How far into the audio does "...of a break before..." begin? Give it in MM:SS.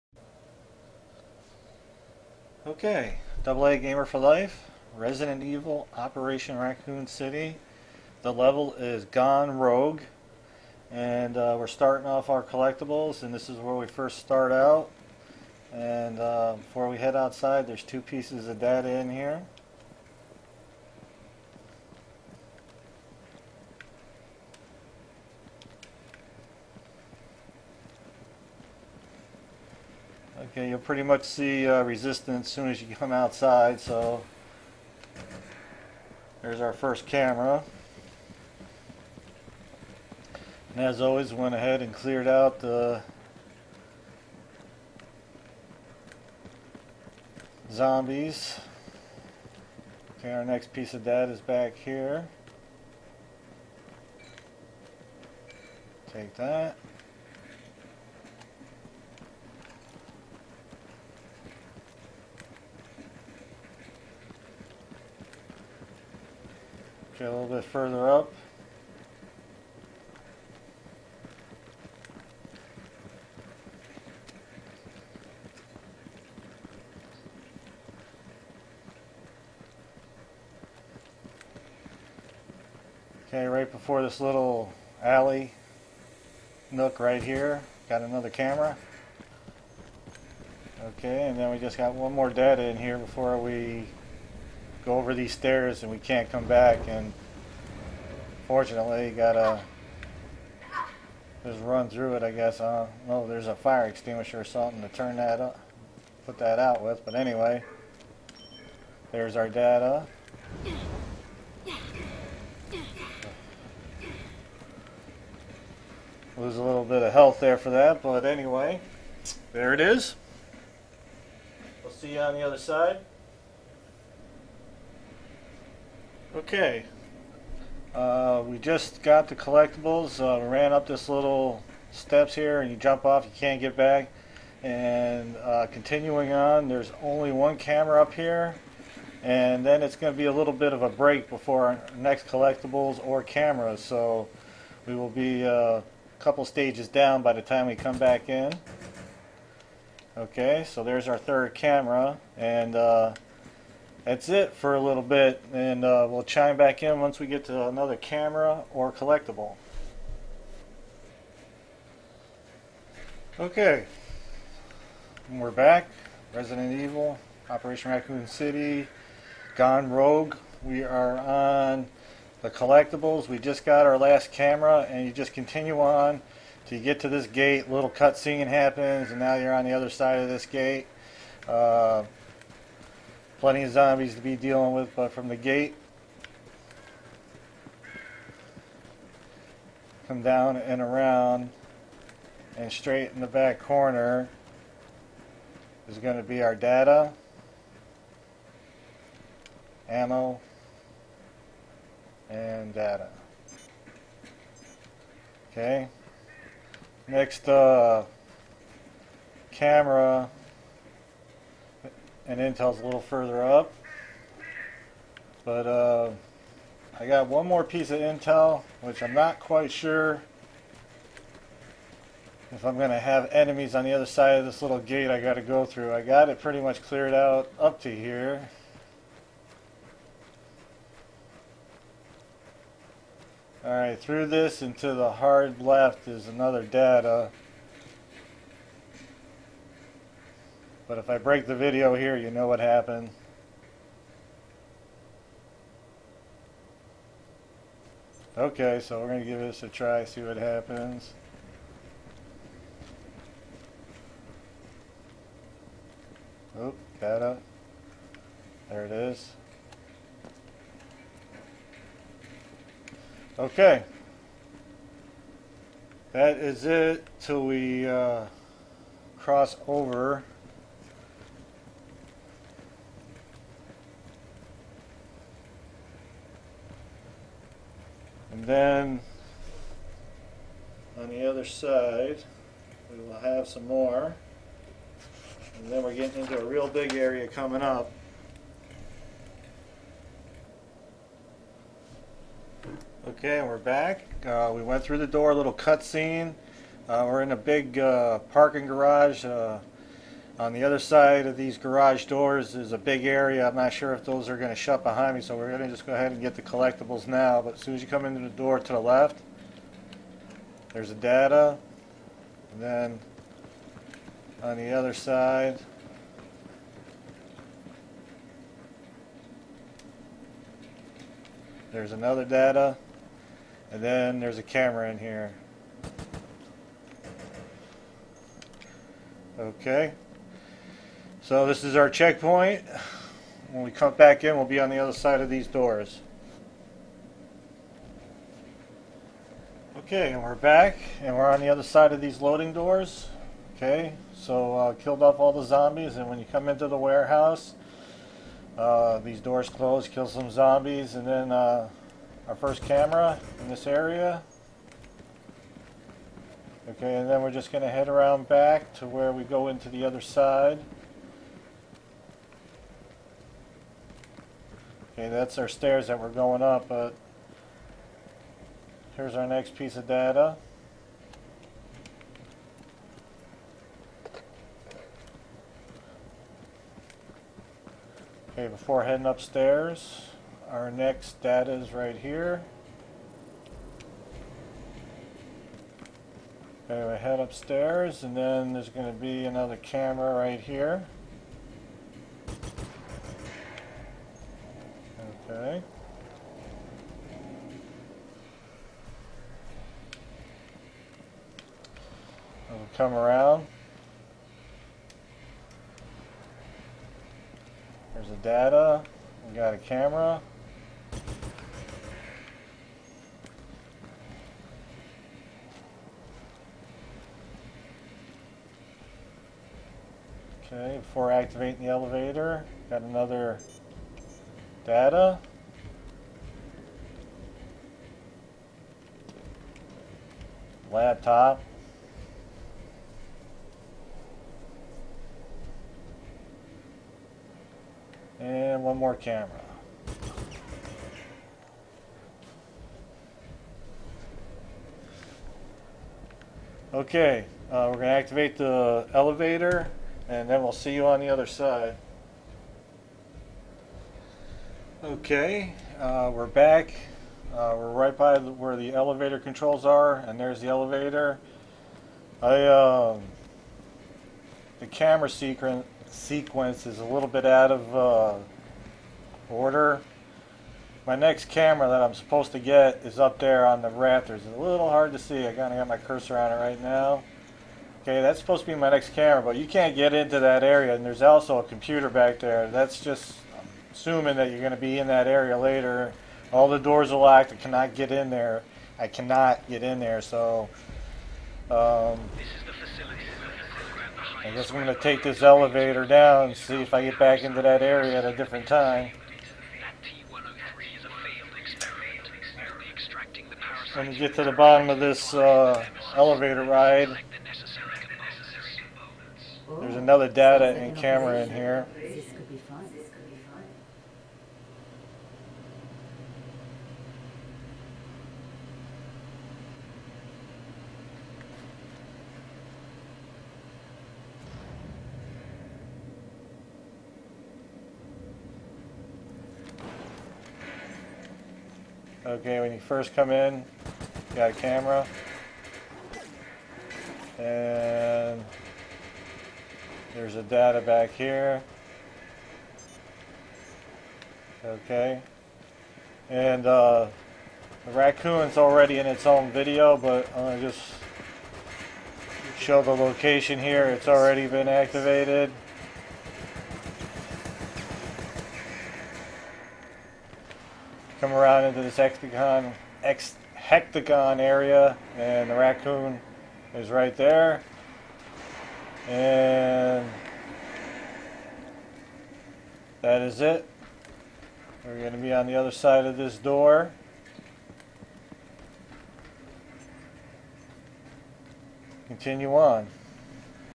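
02:20.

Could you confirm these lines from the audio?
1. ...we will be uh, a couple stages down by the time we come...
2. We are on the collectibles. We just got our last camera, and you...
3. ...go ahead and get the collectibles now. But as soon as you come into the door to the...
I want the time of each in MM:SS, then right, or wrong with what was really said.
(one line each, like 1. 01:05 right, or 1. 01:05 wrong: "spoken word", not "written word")
1. 02:24 right
2. 02:50 right
3. 05:05 right.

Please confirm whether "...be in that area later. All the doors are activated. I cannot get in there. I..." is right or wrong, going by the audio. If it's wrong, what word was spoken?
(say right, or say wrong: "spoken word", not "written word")
wrong: "locked", not "activated".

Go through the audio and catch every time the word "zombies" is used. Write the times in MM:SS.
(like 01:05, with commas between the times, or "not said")
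00:47, 03:03, 05:45, 05:50.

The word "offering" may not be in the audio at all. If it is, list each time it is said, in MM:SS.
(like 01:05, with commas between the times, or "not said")
not said.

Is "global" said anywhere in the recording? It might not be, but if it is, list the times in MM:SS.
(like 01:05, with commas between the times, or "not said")
not said.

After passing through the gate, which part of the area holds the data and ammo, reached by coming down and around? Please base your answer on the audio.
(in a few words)
back corner.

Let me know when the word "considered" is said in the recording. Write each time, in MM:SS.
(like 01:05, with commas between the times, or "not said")
not said.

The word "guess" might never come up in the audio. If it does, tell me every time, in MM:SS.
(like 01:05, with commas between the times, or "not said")
01:42, 08:14.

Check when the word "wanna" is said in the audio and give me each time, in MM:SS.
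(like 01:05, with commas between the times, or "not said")
not said.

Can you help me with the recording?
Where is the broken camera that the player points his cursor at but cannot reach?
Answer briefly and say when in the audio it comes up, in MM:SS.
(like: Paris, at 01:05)
the rafters, at 07:53.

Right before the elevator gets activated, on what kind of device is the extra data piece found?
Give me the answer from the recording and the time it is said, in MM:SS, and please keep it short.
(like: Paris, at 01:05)
Laptop, at 07:10.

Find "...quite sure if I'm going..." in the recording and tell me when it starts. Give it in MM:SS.
03:39.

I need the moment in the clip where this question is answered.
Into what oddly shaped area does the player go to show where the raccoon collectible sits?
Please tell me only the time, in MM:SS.
09:21.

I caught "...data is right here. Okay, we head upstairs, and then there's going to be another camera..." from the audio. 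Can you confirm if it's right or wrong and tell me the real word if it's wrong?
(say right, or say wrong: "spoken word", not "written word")
right.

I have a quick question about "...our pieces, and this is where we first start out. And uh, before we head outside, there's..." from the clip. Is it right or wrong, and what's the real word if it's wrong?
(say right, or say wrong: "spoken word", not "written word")
wrong: "collectibles", not "pieces".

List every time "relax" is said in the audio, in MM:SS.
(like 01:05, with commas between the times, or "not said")
not said.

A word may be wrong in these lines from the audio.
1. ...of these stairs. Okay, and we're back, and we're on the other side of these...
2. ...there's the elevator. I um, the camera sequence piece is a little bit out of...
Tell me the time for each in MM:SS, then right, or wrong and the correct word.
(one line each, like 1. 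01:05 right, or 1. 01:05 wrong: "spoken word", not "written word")
1. 05:35 wrong: "doors", not "stairs"
2. 07:40 wrong: "sequence", not "piece".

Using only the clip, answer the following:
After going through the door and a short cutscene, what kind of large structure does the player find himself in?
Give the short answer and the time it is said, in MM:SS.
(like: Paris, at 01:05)
parking garage, at 04:58.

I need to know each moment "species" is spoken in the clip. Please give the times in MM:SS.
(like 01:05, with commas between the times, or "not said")
not said.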